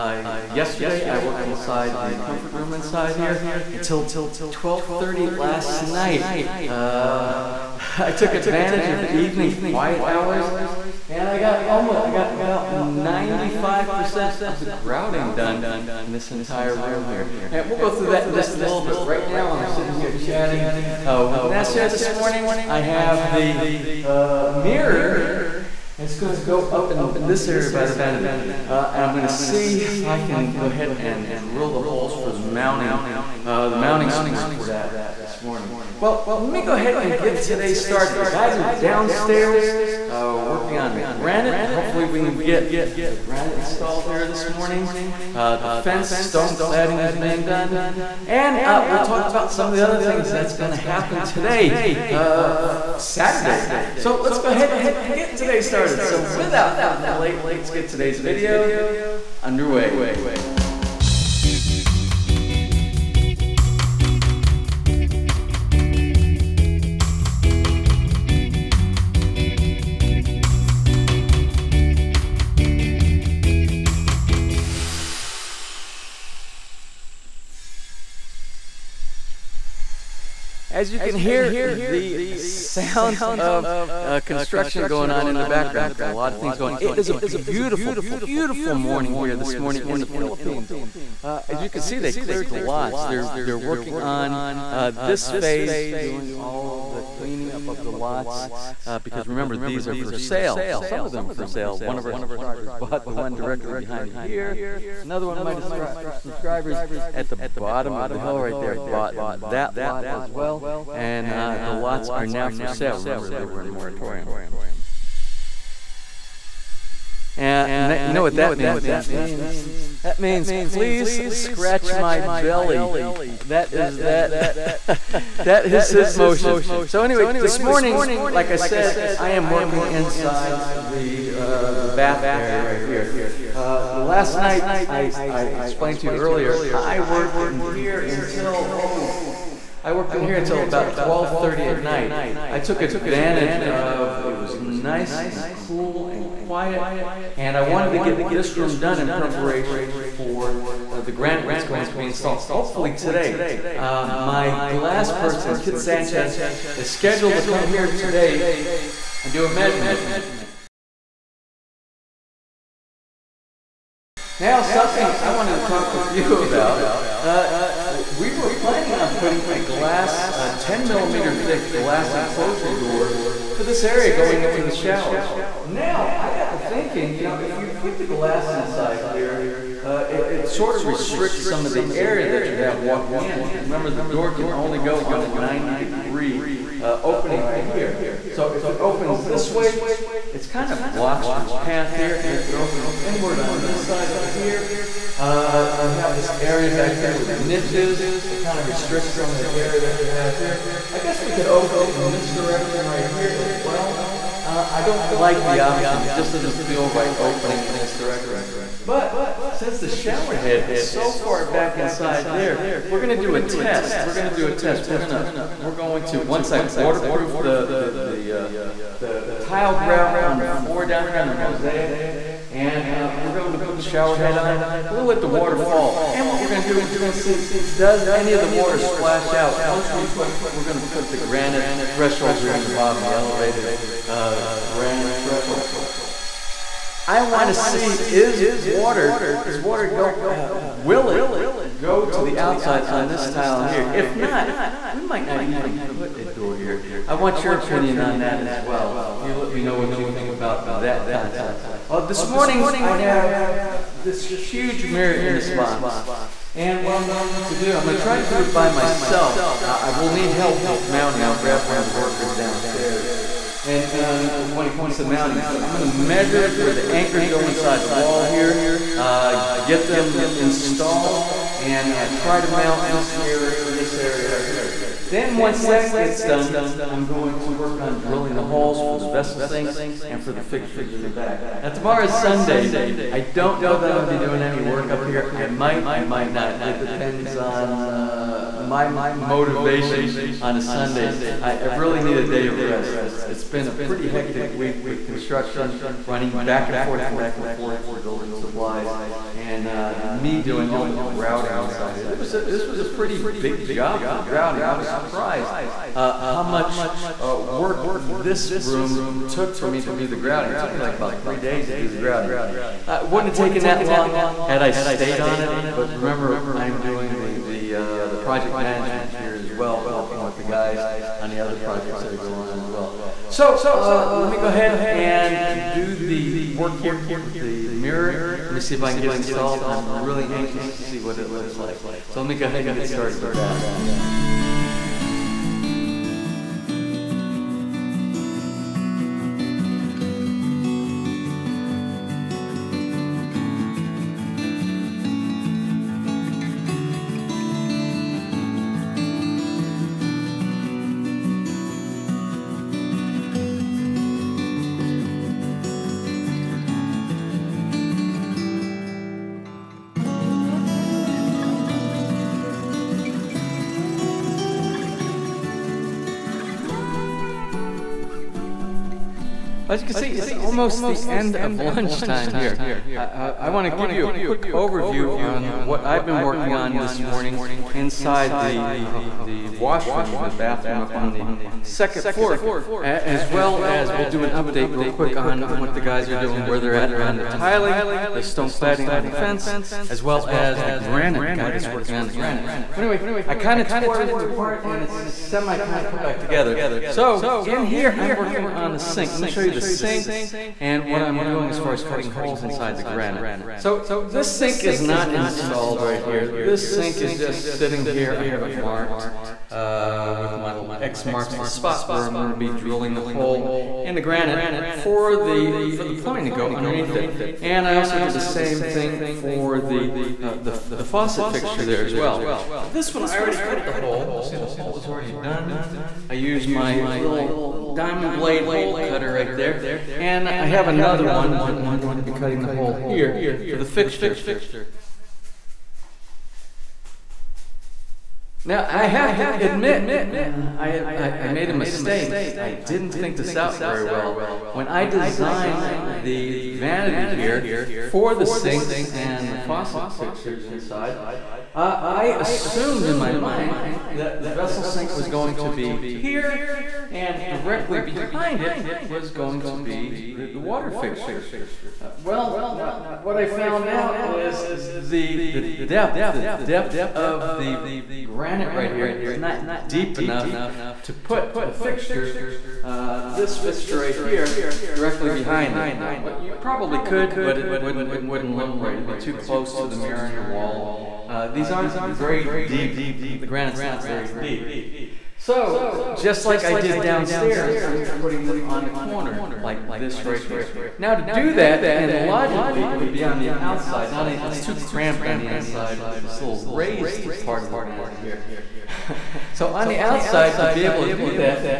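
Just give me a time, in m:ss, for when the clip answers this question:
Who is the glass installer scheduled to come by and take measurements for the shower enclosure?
2:35.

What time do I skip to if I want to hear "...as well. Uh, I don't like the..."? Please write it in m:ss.
3:23.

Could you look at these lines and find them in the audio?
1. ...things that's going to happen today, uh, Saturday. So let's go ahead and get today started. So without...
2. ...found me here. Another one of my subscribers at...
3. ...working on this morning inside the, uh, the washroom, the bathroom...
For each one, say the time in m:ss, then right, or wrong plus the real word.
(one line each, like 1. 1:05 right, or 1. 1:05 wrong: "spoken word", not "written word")
1. 0:50 right
2. 1:43 wrong: "behind", not "found"
3. 6:16 right.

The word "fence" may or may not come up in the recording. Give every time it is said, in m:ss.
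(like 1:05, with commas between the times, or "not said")
0:45, 6:29.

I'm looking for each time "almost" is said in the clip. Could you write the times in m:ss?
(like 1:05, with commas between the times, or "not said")
0:11, 6:10.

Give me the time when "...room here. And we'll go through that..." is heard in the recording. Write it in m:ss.
0:16.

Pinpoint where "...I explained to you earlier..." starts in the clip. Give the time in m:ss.
2:15.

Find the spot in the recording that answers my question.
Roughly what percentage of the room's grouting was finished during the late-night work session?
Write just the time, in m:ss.
0:12.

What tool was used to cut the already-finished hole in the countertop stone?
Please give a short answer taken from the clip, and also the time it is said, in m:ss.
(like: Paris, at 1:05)
Diamond blade hole cutter, at 7:07.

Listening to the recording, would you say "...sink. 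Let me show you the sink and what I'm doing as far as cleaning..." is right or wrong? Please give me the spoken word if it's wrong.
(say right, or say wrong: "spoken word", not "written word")
wrong: "cutting", not "cleaning".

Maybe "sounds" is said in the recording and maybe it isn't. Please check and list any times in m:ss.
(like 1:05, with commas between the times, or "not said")
1:22.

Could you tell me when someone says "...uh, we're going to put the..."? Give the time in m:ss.
3:42.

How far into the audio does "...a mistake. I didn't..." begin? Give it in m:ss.
7:21.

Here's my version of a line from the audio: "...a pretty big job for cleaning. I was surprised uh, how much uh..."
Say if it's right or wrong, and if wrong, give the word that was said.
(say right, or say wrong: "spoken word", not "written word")
wrong: "grouting", not "cleaning".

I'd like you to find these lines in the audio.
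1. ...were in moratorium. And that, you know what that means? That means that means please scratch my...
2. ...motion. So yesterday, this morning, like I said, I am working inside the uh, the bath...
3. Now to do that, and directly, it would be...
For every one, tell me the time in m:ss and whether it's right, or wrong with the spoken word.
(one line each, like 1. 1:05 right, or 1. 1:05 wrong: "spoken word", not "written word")
1. 1:53 right
2. 2:06 wrong: "anyway", not "yesterday"
3. 8:10 wrong: "logically", not "directly".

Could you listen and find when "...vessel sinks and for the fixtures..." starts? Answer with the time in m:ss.
4:39.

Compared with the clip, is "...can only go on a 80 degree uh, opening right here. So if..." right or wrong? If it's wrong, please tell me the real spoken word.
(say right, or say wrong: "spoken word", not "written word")
wrong: "90", not "80".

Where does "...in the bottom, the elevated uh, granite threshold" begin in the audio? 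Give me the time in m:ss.
3:52.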